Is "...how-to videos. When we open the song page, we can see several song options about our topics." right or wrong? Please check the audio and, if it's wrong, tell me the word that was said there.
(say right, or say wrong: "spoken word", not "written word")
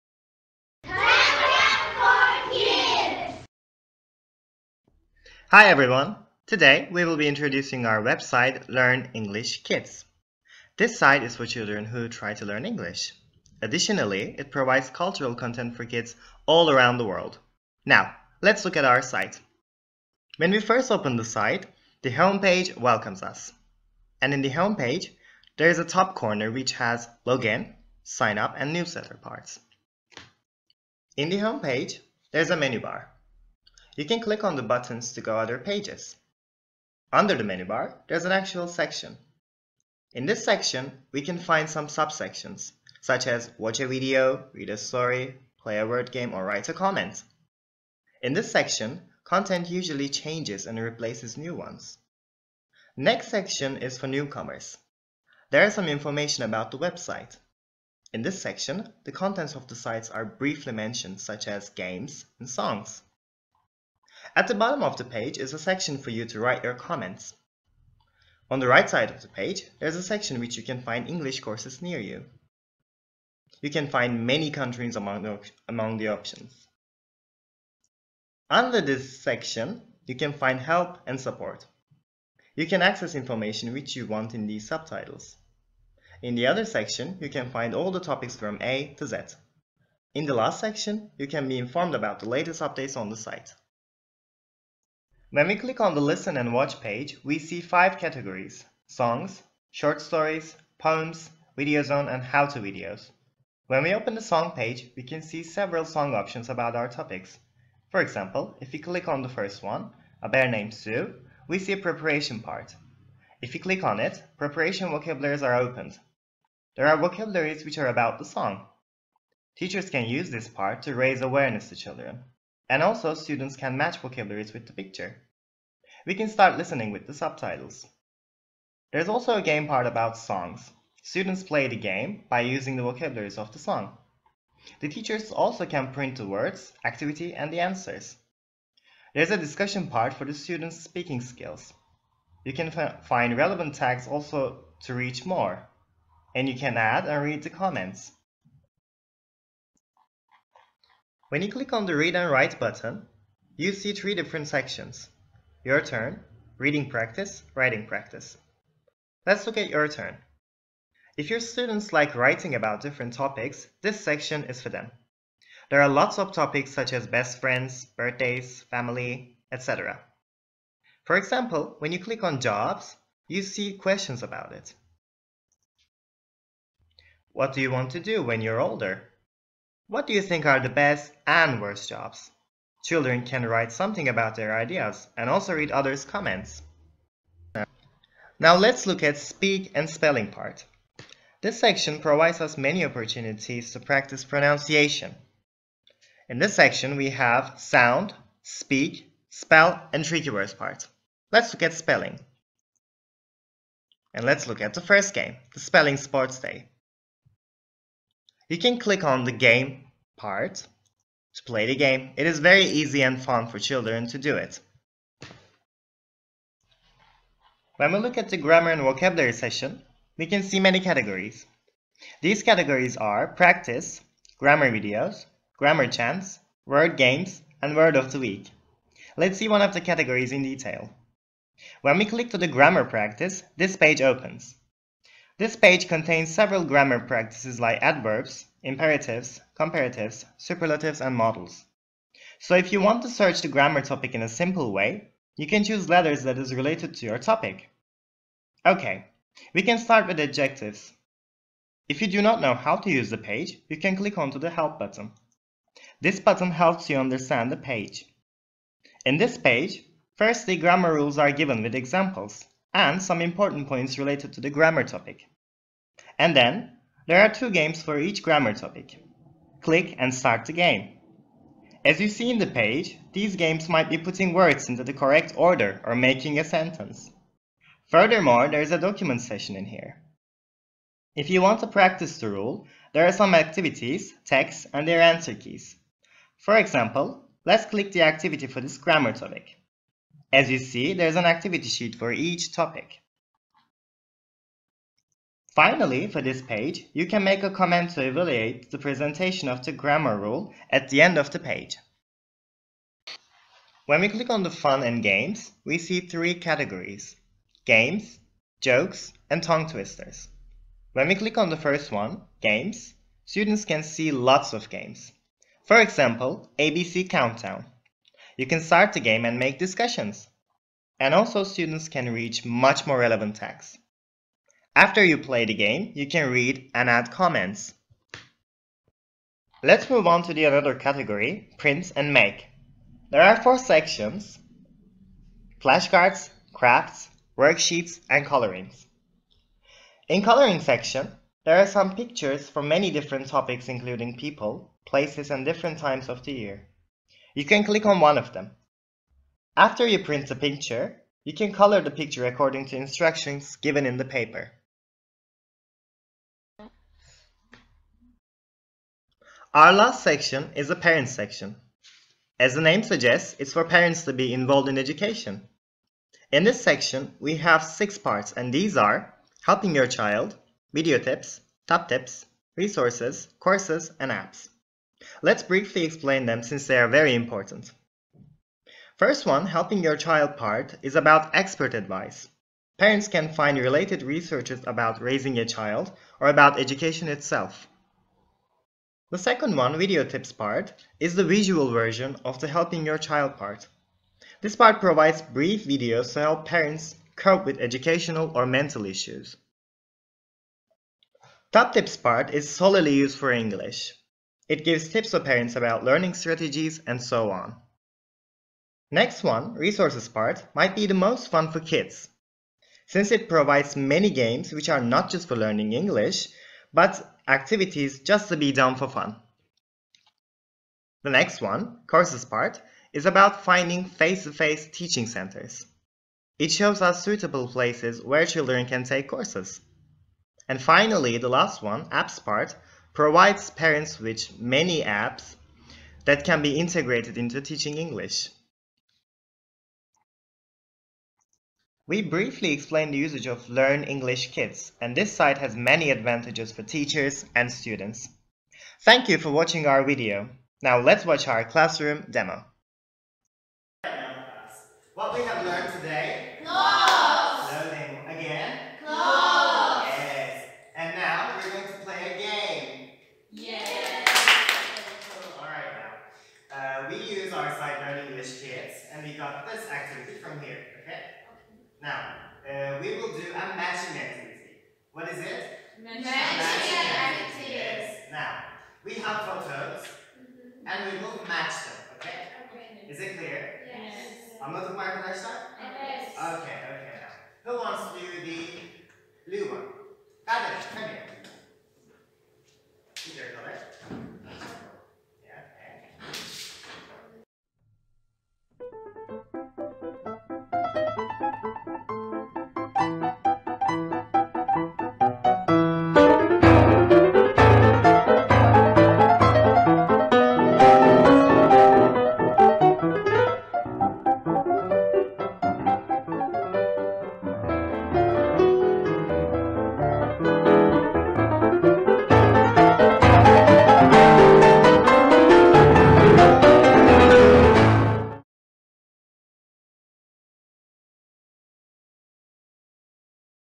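right.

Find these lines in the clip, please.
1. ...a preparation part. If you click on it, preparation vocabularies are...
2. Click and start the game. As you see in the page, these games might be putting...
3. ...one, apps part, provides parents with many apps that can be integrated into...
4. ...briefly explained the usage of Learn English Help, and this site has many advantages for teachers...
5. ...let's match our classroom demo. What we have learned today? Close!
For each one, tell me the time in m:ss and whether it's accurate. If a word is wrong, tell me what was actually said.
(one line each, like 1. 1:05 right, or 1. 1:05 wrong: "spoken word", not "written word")
1. 1:51 right
2. 4:29 right
3. 7:11 right
4. 7:22 wrong: "Kids", not "Help"
5. 7:30 wrong: "watch", not "match".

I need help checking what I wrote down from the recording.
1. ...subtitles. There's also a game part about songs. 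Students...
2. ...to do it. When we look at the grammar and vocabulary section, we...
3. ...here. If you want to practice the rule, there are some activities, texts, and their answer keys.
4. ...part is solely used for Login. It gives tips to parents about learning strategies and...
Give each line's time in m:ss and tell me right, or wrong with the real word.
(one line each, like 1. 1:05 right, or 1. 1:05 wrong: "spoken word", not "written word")
1. 2:07 right
2. 3:34 right
3. 4:39 right
4. 6:41 wrong: "English", not "Login".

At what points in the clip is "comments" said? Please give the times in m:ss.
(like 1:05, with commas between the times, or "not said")
0:46, 1:06, 2:27, 3:06, 4:57, 5:27.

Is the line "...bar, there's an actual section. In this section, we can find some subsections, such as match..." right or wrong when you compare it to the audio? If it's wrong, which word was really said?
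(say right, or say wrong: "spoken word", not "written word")
wrong: "watch", not "match".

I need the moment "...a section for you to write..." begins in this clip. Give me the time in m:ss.
1:05.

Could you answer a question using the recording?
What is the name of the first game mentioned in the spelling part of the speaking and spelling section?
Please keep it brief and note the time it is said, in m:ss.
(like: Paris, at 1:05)
Spelling Sports Day, at 3:25.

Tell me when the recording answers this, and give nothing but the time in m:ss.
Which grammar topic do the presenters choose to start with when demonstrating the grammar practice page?
4:10.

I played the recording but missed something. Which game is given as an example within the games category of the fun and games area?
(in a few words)
ABC Countdown.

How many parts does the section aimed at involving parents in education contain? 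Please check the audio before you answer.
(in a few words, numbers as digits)
6.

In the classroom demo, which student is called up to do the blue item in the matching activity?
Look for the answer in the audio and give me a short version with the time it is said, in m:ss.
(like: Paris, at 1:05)
Adam, at 8:10.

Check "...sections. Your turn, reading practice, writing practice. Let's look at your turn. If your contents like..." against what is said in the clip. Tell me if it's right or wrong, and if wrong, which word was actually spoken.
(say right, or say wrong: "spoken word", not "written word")
wrong: "students", not "contents".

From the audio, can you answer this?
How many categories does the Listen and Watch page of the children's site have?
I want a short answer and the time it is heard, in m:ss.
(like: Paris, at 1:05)
5, at 1:37.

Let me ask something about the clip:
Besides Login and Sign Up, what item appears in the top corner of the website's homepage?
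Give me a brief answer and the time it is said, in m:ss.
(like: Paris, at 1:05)
Newsletter, at 0:28.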